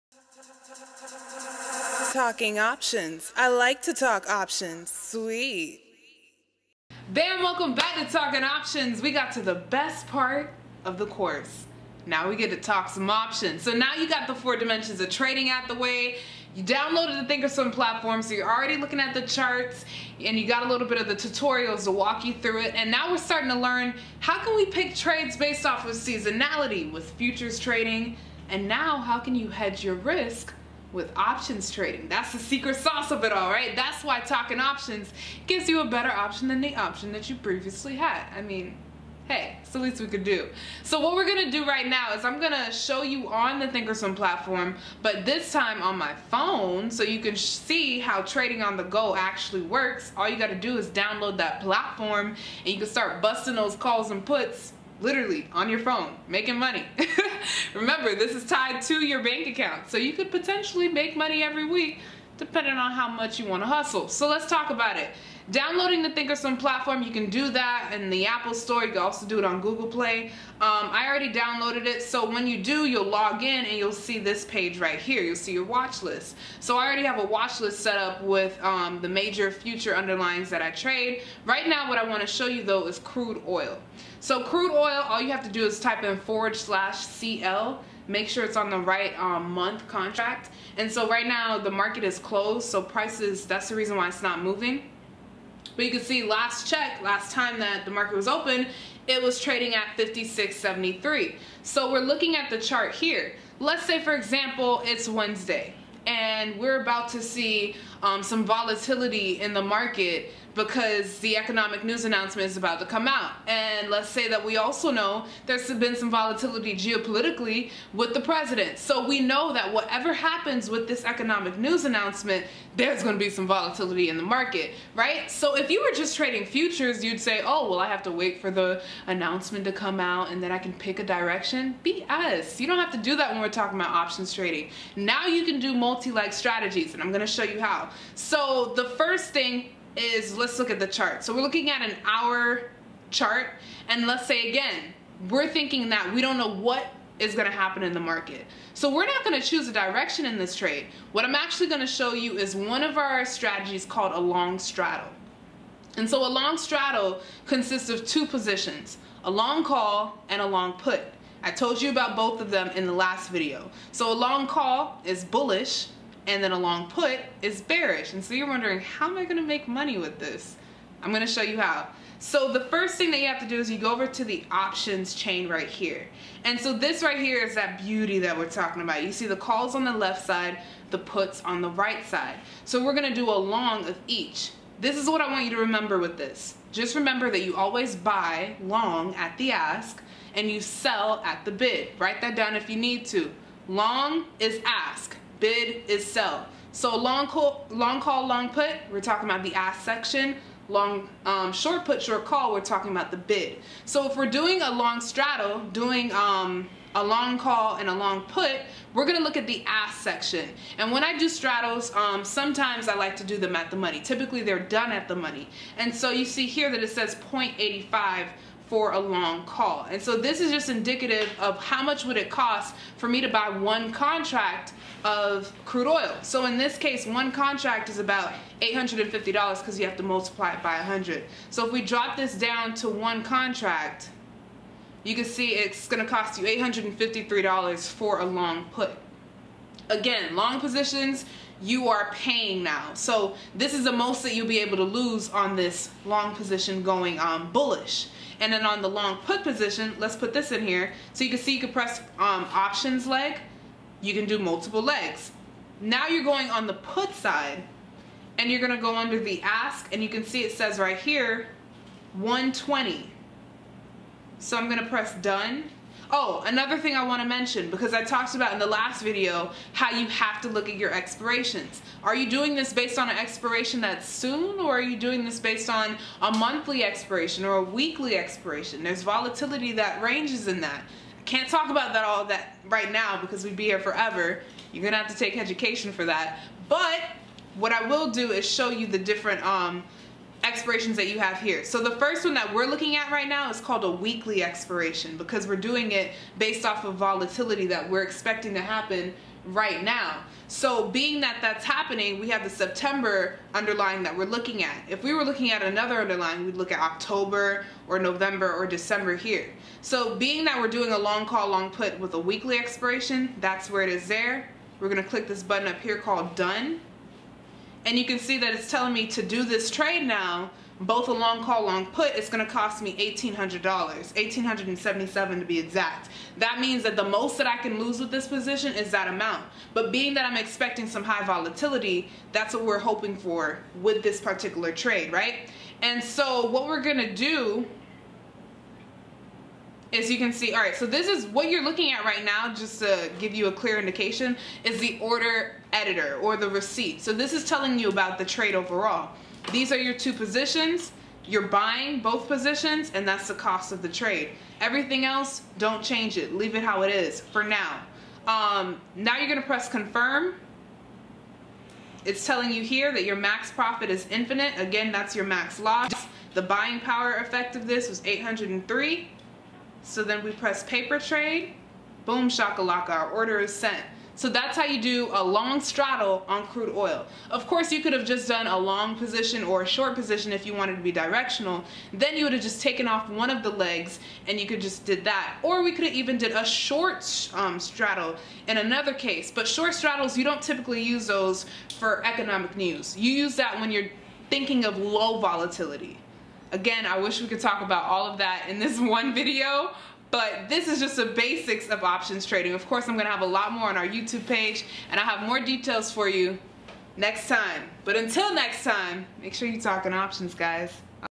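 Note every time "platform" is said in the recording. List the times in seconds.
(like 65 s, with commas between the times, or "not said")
17 s, 44 s, 51 s, 66 s.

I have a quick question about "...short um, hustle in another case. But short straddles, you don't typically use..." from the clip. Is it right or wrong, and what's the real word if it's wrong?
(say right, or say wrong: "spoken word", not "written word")
wrong: "straddle", not "hustle".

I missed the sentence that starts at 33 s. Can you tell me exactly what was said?
That's why talking options gives you a better option than the option that you previously had.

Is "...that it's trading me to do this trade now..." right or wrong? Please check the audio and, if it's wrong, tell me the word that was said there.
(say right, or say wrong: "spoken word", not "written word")
wrong: "telling", not "trading".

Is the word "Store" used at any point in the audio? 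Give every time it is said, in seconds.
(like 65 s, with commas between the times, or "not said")
68 s.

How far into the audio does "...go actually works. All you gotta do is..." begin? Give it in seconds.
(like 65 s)
48 s.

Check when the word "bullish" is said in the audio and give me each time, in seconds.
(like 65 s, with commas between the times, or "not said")
165 s, 247 s.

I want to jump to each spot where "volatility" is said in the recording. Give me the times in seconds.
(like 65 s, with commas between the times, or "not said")
108 s, 116 s, 123 s, 279 s, 296 s, 331 s, 395 s.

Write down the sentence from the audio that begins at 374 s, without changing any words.
So that's how you do a long straddle on crude oil.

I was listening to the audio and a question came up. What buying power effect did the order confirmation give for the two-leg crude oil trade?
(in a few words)
803.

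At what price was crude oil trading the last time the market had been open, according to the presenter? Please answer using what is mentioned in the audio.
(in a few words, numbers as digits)
56.73.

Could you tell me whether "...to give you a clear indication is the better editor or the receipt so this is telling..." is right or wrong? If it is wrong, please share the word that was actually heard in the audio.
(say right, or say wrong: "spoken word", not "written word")
wrong: "order", not "better".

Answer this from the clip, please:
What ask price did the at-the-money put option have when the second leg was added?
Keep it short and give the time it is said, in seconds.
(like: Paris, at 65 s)
120, at 262 s.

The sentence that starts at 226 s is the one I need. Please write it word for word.
So in this case, one contract is about $850 because you have to multiply it by 100.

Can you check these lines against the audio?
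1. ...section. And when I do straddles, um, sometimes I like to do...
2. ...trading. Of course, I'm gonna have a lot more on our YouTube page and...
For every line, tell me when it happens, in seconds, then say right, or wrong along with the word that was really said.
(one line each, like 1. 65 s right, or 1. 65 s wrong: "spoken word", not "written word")
1. 210 s right
2. 402 s right.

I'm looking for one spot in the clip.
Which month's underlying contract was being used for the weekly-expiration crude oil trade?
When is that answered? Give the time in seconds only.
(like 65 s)
302 s.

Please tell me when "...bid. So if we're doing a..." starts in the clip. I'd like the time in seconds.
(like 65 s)
203 s.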